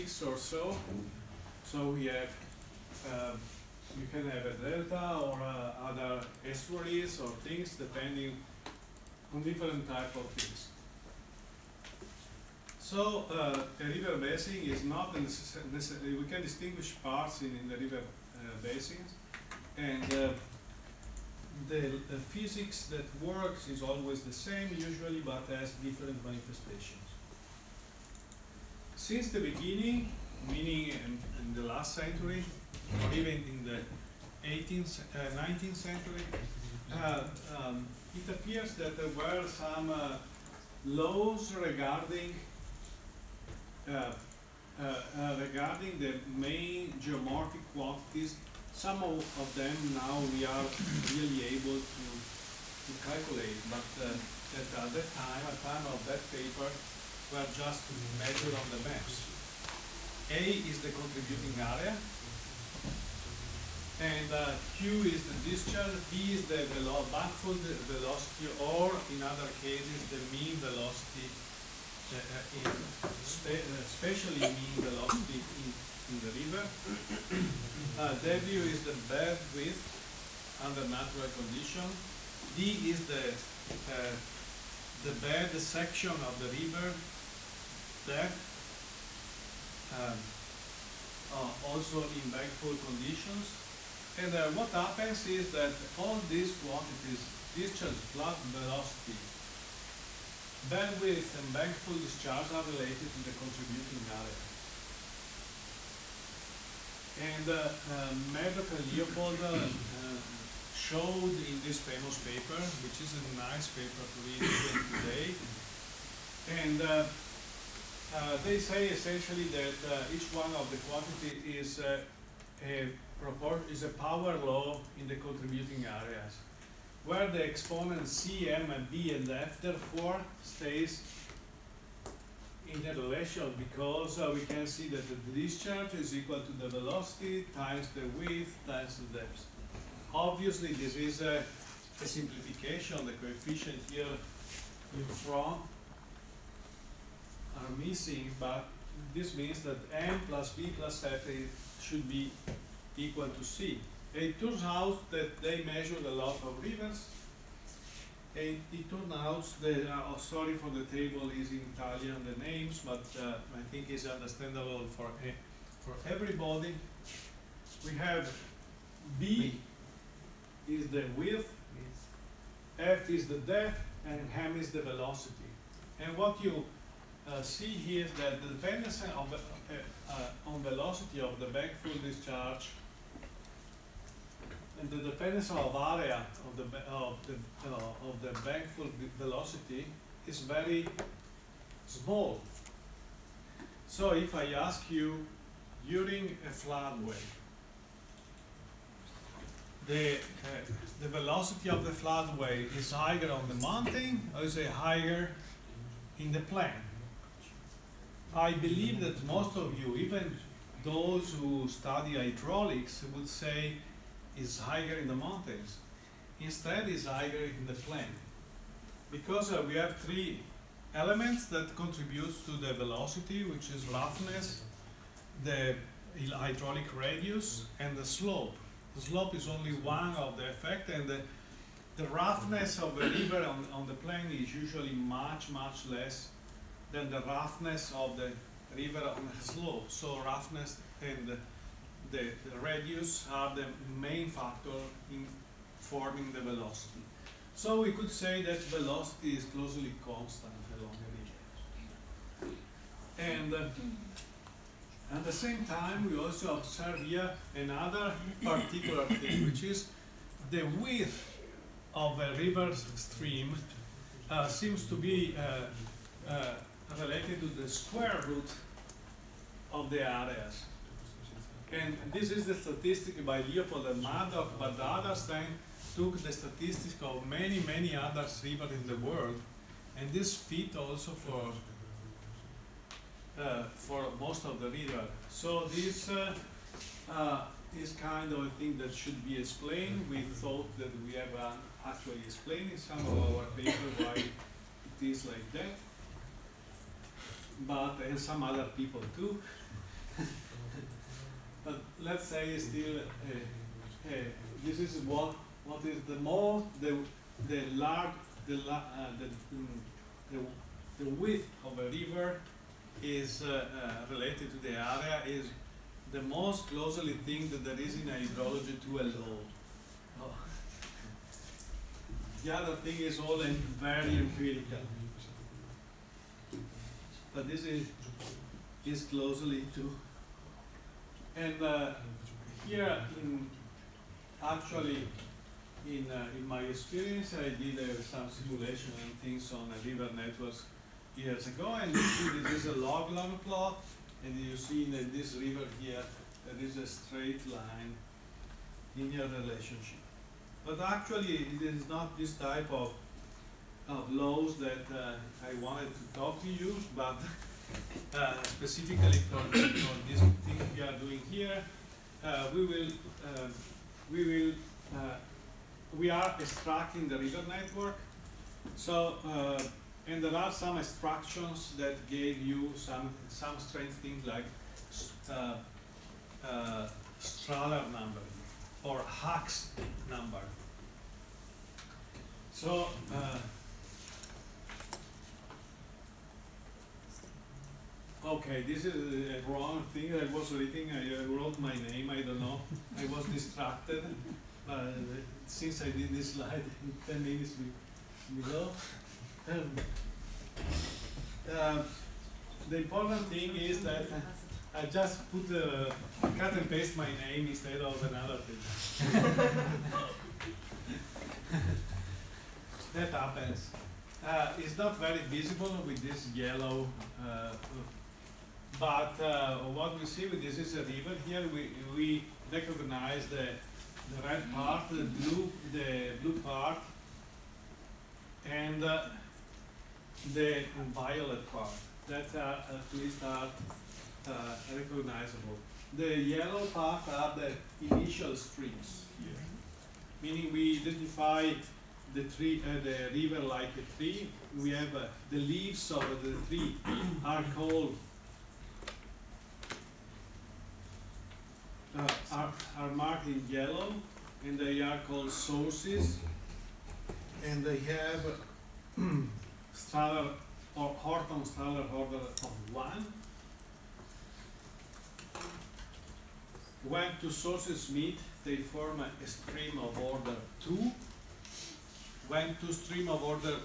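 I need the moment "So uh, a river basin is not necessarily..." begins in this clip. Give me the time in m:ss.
0:12.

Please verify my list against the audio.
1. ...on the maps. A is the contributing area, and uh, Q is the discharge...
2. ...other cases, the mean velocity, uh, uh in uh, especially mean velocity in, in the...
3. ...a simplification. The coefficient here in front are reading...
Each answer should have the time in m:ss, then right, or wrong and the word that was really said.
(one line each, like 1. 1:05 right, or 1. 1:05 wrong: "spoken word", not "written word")
1. 0:58 right
2. 1:09 right
3. 2:22 wrong: "missing", not "reading".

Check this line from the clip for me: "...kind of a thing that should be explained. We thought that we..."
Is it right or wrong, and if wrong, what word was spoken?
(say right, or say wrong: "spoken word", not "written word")
right.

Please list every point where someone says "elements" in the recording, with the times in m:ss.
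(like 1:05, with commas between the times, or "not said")
3:40.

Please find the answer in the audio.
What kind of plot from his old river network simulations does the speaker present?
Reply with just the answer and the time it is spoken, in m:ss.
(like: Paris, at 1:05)
Log log plot, at 5:42.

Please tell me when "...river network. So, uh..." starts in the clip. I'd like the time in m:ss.
6:07.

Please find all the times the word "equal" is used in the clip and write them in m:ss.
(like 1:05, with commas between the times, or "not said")
2:16, 2:32.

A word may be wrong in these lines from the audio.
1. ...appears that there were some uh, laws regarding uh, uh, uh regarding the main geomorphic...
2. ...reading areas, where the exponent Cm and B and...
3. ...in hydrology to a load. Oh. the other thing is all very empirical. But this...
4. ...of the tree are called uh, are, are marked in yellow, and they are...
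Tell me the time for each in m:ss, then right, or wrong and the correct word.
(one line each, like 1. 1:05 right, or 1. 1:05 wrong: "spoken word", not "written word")
1. 0:38 right
2. 2:05 wrong: "contributing", not "reading"
3. 5:17 right
4. 7:25 right.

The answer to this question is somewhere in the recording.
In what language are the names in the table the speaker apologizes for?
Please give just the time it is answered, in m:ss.
2:41.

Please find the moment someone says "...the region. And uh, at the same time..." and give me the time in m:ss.
4:11.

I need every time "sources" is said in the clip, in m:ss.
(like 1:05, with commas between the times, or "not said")
7:35, 7:47.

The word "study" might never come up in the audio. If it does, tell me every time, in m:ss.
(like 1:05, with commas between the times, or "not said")
3:31.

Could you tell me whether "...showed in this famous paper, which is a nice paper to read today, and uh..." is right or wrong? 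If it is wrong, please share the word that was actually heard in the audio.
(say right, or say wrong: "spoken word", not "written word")
right.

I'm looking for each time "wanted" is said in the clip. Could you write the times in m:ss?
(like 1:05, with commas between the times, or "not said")
5:55.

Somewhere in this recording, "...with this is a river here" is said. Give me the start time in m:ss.
7:00.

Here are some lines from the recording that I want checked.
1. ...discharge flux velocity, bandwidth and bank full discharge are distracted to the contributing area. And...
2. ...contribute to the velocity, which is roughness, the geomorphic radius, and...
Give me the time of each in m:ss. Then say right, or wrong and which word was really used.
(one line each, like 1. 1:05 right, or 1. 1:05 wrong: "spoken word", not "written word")
1. 1:37 wrong: "related", not "distracted"
2. 3:41 wrong: "hydraulic", not "geomorphic".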